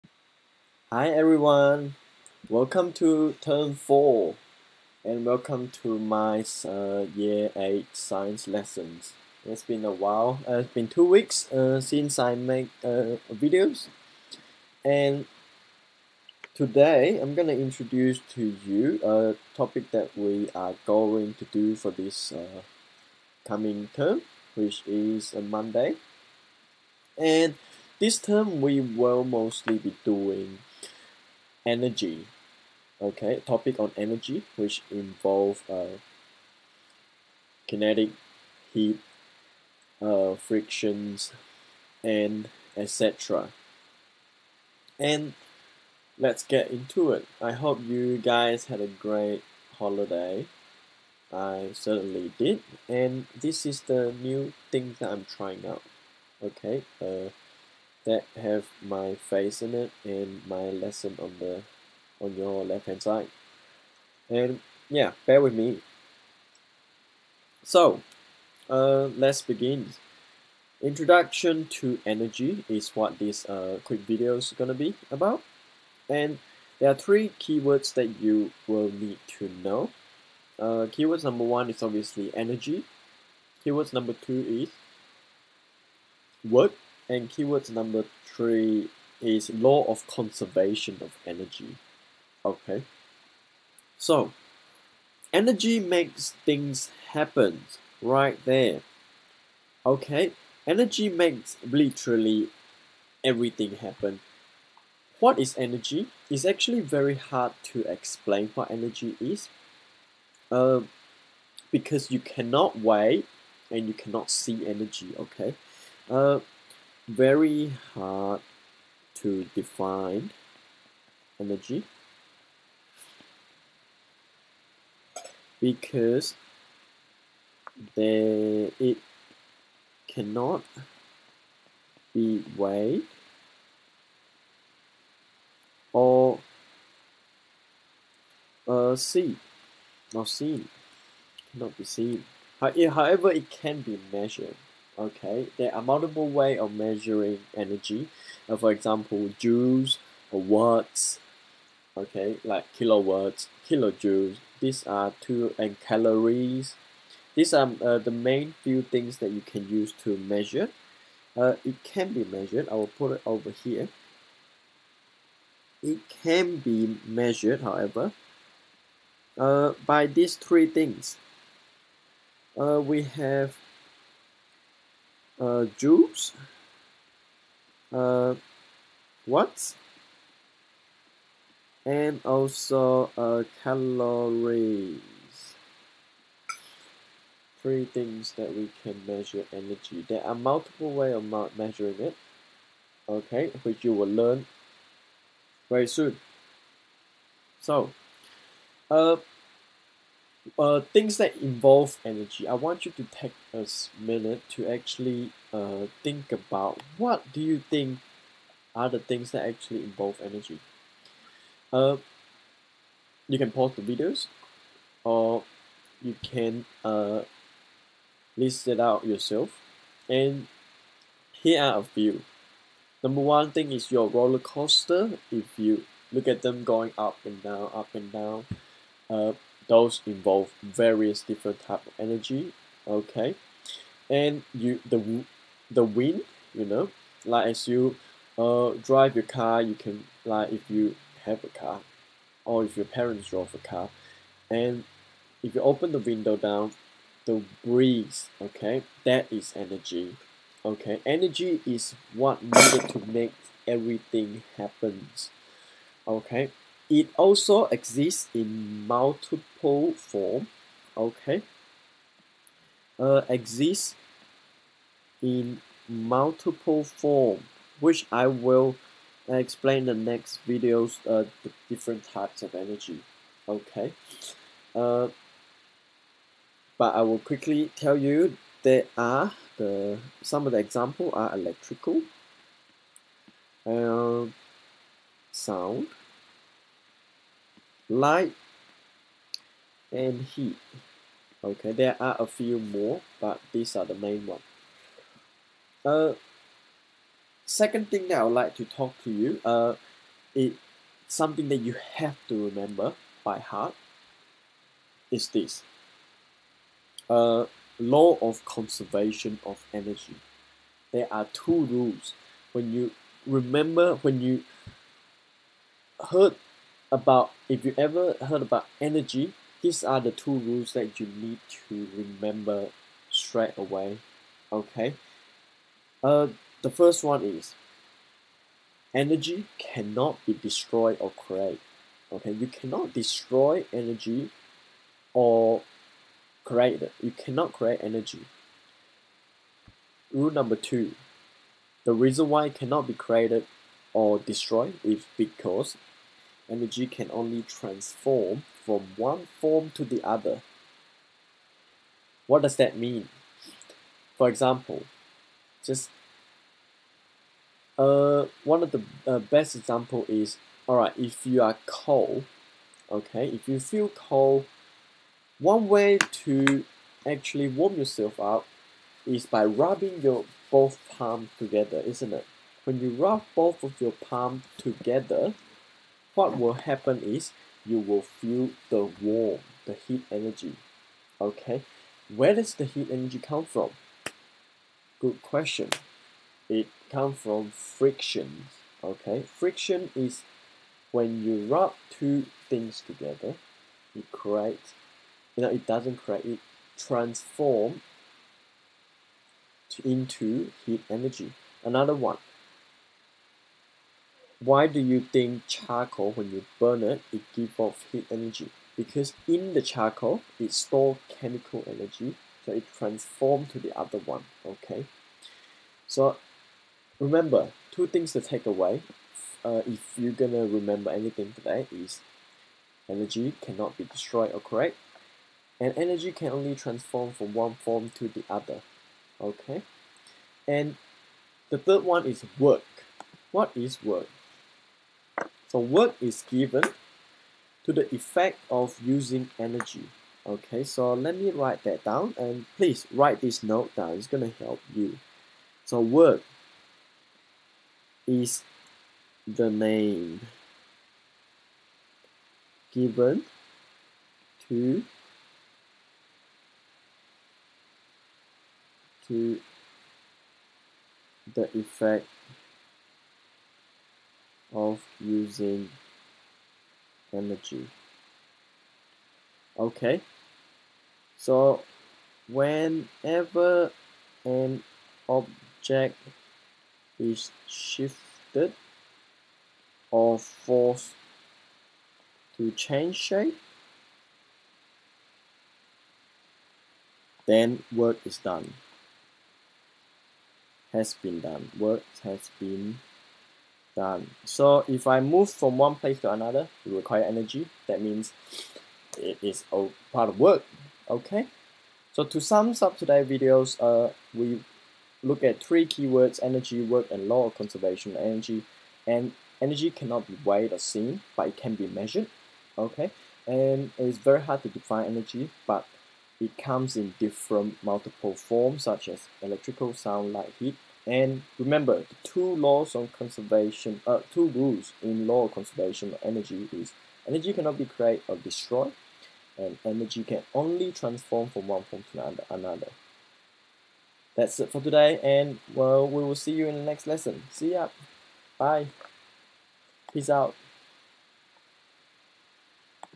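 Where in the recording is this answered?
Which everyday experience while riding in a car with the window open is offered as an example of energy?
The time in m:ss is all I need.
4:07.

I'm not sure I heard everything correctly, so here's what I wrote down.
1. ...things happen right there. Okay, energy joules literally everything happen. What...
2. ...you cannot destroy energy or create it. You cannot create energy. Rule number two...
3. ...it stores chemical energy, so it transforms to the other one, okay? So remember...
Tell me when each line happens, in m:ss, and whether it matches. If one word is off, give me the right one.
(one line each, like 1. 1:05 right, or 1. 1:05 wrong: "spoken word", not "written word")
1. 1:36 wrong: "makes", not "joules"
2. 5:32 right
3. 6:50 right.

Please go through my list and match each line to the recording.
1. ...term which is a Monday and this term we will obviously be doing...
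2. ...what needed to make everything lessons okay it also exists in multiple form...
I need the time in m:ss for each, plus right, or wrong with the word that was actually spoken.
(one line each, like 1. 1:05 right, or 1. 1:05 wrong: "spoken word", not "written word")
1. 0:23 wrong: "mostly", not "obviously"
2. 4:12 wrong: "happens", not "lessons".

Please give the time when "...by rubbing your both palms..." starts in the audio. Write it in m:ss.
6:09.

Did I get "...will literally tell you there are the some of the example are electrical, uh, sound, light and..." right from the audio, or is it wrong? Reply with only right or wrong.
wrong.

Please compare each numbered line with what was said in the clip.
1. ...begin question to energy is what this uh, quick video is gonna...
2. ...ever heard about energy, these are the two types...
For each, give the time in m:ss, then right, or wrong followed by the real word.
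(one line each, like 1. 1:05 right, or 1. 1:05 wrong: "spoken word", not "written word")
1. 1:09 wrong: "introduction", not "question"
2. 5:17 wrong: "rules", not "types".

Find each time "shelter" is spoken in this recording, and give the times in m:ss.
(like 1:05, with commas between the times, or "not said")
not said.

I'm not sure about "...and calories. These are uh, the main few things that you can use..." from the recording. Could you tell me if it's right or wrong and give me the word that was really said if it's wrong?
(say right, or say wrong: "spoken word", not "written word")
right.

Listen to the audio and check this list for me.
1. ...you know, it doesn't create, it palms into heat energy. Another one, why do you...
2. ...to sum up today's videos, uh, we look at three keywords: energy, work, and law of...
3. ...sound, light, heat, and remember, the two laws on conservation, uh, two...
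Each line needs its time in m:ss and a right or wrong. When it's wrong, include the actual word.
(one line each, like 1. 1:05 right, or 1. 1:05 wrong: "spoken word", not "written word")
1. 6:35 wrong: "transforms", not "palms"
2. 8:22 right
3. 8:39 right.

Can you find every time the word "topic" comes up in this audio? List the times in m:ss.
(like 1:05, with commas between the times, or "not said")
0:19, 0:33.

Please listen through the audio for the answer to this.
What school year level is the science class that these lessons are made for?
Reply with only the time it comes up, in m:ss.
0:07.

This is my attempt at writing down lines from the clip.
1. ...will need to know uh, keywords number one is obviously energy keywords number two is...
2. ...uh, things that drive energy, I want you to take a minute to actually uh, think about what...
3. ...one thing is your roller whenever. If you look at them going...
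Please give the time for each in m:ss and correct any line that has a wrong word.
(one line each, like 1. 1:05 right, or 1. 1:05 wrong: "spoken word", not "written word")
1. 1:18 right
2. 3:20 wrong: "involve", not "drive"
3. 3:43 wrong: "coaster", not "whenever".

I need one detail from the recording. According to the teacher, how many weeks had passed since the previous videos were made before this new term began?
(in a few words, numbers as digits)
2.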